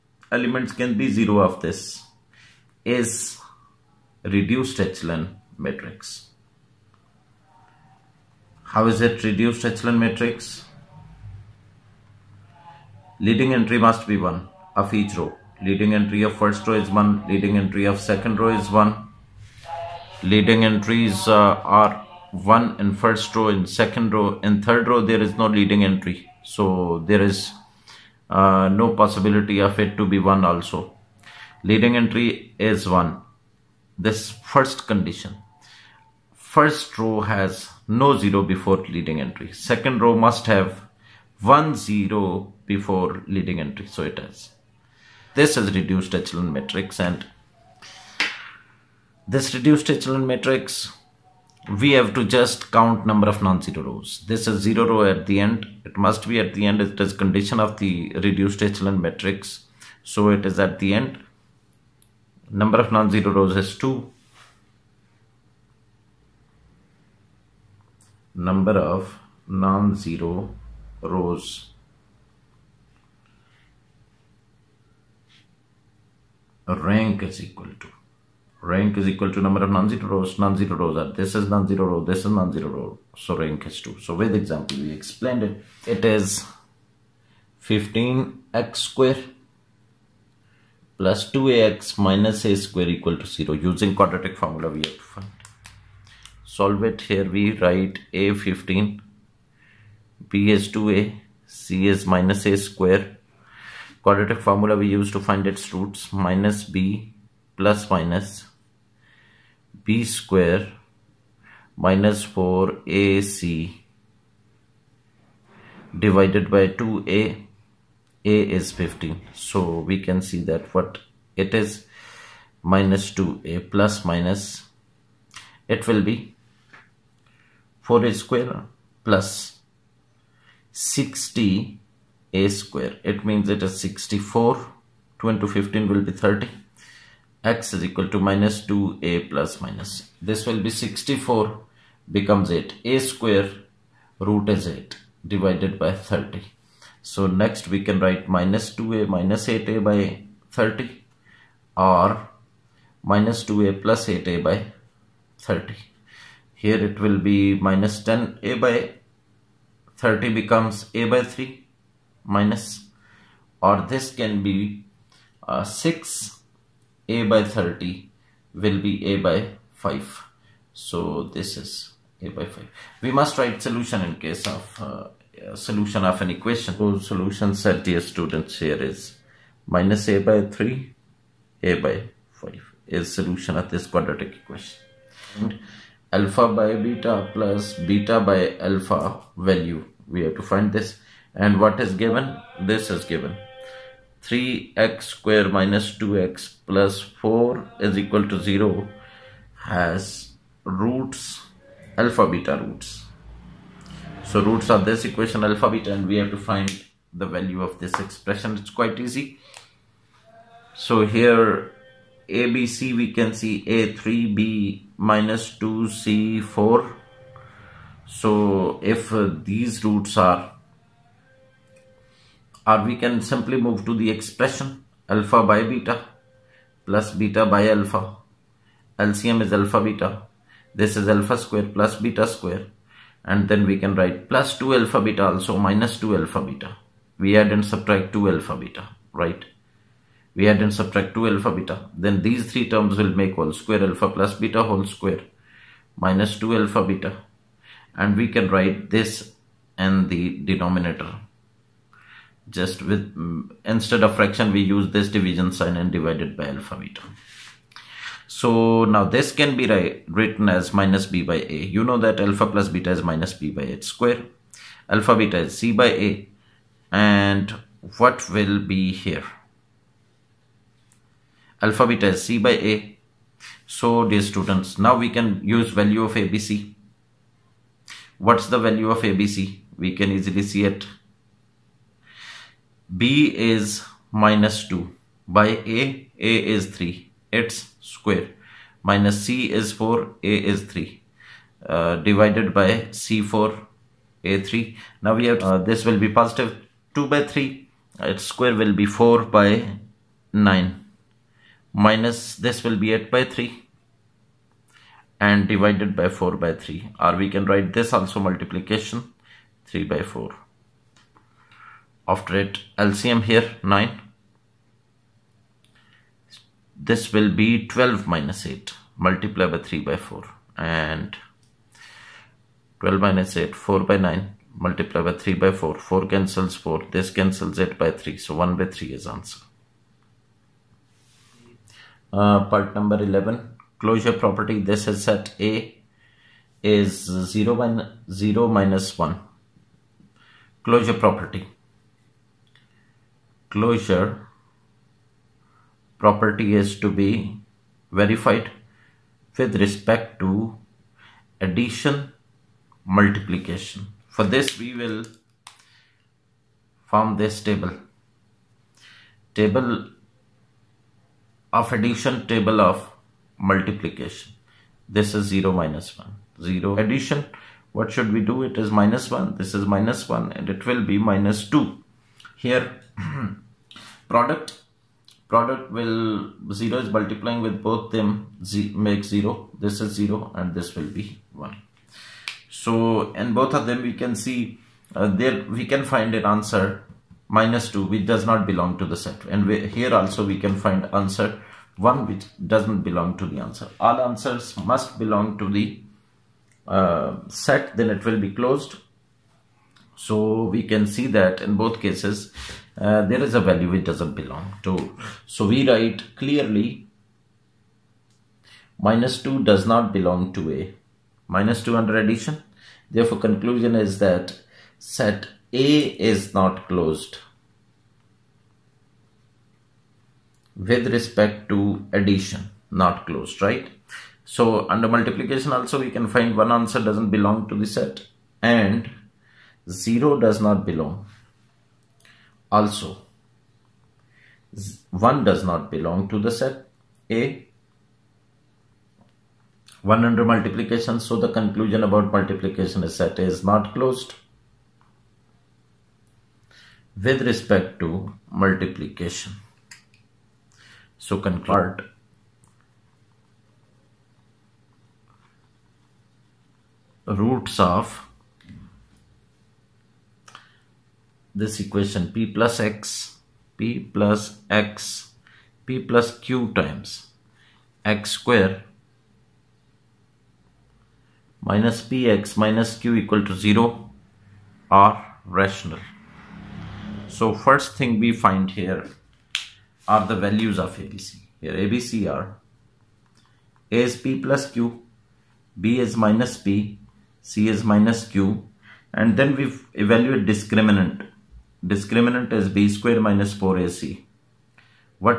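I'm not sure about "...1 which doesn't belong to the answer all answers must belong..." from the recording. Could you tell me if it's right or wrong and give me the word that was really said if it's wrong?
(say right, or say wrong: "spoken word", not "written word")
right.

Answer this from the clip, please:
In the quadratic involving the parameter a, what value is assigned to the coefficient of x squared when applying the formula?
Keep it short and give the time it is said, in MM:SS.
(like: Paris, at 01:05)
15, at 01:38.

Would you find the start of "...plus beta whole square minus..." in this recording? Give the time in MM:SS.
04:04.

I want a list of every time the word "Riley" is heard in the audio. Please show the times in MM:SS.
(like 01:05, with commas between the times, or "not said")
not said.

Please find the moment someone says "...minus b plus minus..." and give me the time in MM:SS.
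01:46.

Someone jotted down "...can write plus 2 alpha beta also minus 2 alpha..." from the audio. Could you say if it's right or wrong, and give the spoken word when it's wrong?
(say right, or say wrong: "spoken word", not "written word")
right.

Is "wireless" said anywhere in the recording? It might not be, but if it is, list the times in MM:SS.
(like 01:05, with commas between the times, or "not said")
not said.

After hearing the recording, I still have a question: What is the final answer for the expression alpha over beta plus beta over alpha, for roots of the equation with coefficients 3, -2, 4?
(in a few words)
1/3.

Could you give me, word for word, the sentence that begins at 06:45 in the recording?
So we write clearly minus 2 does not belong to A.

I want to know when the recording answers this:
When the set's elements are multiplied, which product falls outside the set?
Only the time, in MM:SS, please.
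07:14.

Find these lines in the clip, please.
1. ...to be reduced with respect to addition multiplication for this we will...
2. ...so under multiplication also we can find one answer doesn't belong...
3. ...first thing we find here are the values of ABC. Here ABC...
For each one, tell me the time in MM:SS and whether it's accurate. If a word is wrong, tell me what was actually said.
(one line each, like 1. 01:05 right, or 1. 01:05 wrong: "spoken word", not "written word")
1. 05:46 wrong: "verified", not "reduced"
2. 07:04 right
3. 07:57 right.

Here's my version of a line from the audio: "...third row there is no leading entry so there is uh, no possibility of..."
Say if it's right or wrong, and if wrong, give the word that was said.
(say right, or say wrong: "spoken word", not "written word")
right.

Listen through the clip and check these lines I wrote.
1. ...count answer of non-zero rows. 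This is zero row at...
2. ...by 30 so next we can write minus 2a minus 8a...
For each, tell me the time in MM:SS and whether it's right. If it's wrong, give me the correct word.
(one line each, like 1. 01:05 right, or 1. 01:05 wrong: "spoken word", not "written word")
1. 00:52 wrong: "number", not "answer"
2. 02:25 right.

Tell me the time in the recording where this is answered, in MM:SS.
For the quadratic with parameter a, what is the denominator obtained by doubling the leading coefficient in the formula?
02:15.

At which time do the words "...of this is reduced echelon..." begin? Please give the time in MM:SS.
00:01.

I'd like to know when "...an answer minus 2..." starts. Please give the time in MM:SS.
06:26.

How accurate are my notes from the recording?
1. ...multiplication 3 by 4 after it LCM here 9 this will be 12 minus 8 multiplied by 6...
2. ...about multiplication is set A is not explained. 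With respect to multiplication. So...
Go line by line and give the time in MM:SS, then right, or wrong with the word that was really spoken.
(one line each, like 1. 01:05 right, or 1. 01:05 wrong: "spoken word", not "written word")
1. 05:08 wrong: "3", not "6"
2. 07:21 wrong: "closed", not "explained".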